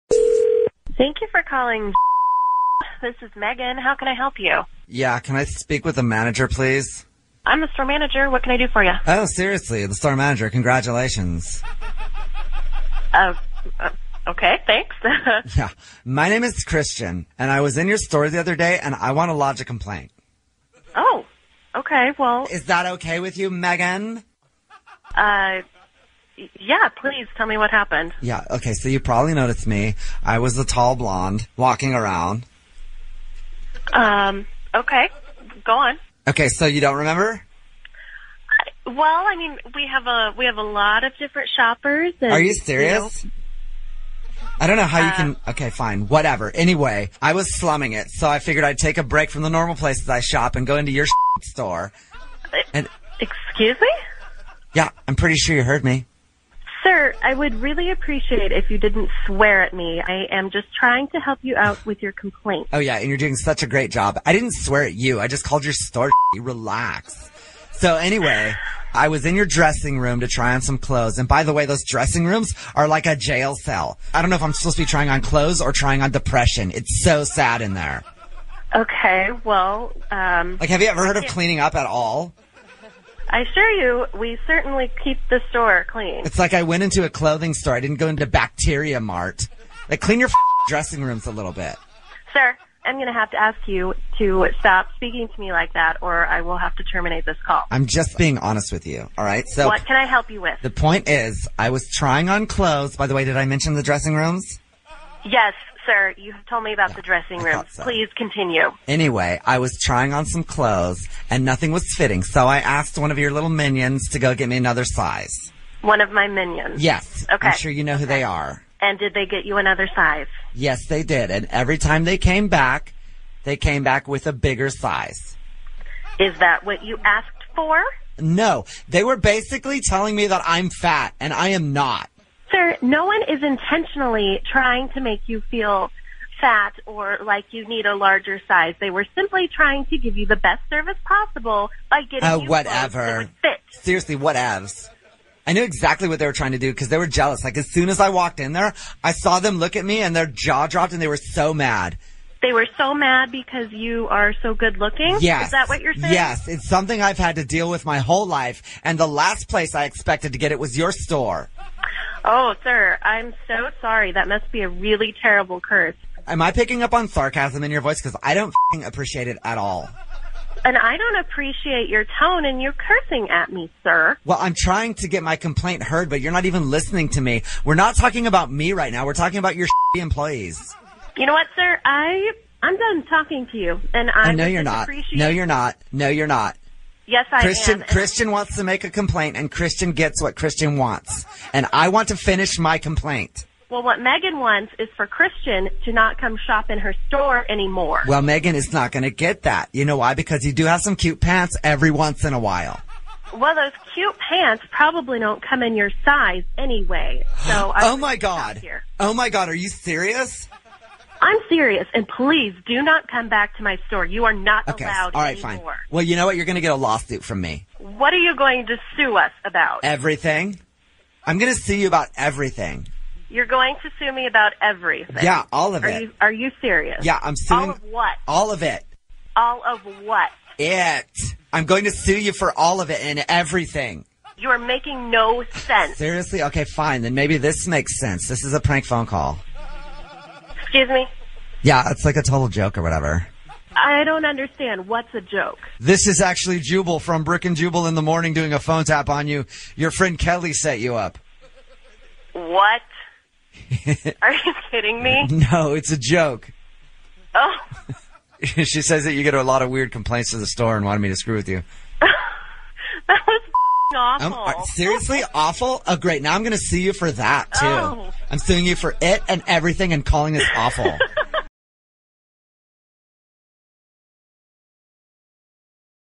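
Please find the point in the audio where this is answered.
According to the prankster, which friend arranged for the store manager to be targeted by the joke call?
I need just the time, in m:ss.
4:10.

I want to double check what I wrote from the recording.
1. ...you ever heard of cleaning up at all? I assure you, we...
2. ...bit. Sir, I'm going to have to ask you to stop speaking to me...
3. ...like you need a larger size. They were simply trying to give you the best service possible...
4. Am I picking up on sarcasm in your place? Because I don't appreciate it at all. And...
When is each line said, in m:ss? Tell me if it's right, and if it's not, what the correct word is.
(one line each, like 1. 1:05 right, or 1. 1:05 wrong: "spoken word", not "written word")
1. 1:20 right
2. 1:31 right
3. 2:17 right
4. 2:46 wrong: "voice", not "place".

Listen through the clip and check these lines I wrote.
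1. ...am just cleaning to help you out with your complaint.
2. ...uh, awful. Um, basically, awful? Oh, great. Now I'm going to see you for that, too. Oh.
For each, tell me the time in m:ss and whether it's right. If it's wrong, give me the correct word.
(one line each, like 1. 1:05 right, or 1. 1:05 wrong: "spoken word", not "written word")
1. 1:00 wrong: "trying", not "cleaning"
2. 4:23 wrong: "seriously", not "basically".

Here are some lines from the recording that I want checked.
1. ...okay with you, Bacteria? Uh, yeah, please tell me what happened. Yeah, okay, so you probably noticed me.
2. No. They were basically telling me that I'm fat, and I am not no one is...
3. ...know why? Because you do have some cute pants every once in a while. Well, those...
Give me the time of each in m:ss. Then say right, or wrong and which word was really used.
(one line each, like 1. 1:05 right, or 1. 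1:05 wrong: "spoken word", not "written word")
1. 0:22 wrong: "Megan", not "Bacteria"
2. 2:08 right
3. 3:19 right.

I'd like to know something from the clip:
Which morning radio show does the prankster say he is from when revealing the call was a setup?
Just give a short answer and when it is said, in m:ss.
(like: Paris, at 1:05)
Brooke and Jubal in the morning, at 4:07.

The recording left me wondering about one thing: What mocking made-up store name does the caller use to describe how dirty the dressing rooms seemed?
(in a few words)
Bacteria Mart.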